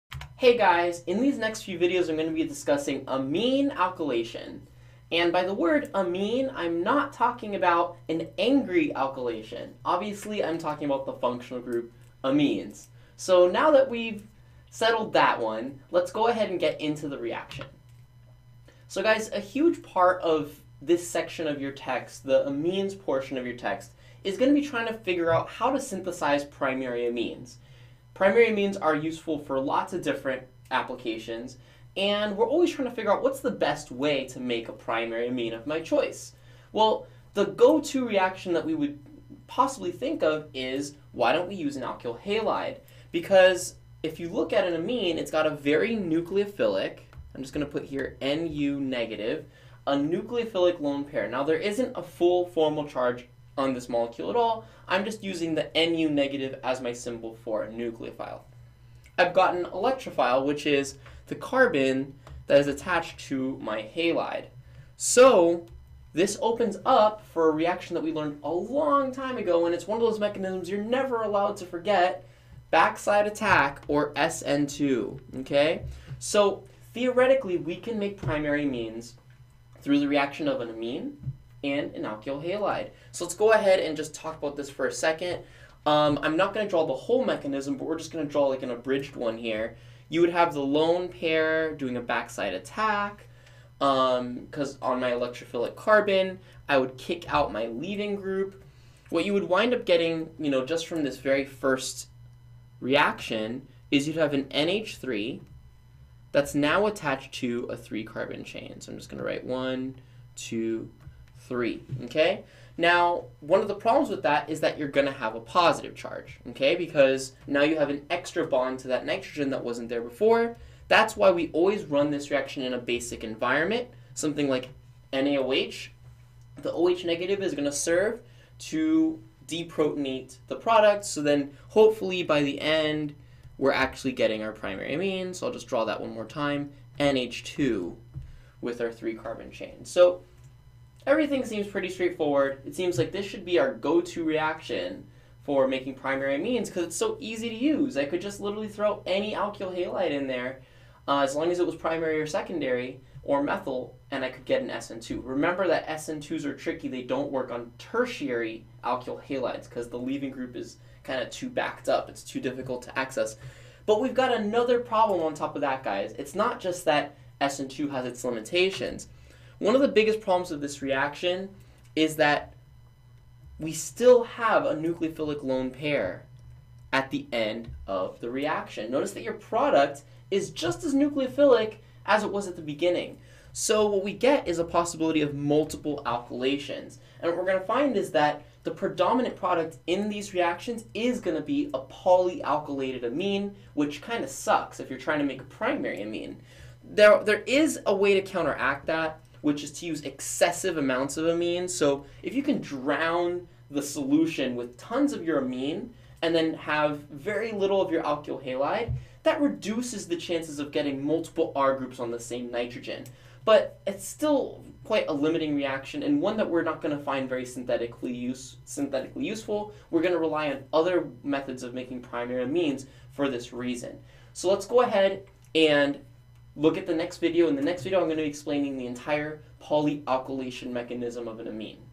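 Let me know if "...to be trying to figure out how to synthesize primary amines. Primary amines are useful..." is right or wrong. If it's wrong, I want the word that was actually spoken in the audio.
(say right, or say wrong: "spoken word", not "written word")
right.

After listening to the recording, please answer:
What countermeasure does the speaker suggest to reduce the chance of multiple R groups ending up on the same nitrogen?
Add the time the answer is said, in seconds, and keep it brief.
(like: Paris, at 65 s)
excessive amounts of amine, at 200 s.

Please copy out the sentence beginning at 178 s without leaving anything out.
Notice that your product is just as nucleophilic as it was at the beginning.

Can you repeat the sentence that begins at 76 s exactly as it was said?
So theoretically, we can make primary amines through the reaction of an amine and an alkyl halide.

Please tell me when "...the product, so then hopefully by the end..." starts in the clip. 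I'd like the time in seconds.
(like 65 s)
130 s.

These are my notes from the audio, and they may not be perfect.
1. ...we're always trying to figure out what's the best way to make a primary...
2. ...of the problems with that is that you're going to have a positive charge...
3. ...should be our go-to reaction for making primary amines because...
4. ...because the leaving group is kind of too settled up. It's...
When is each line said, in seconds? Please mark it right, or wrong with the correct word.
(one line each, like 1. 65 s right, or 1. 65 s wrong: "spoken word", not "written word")
1. 32 s right
2. 113 s right
3. 143 s right
4. 159 s wrong: "backed", not "settled".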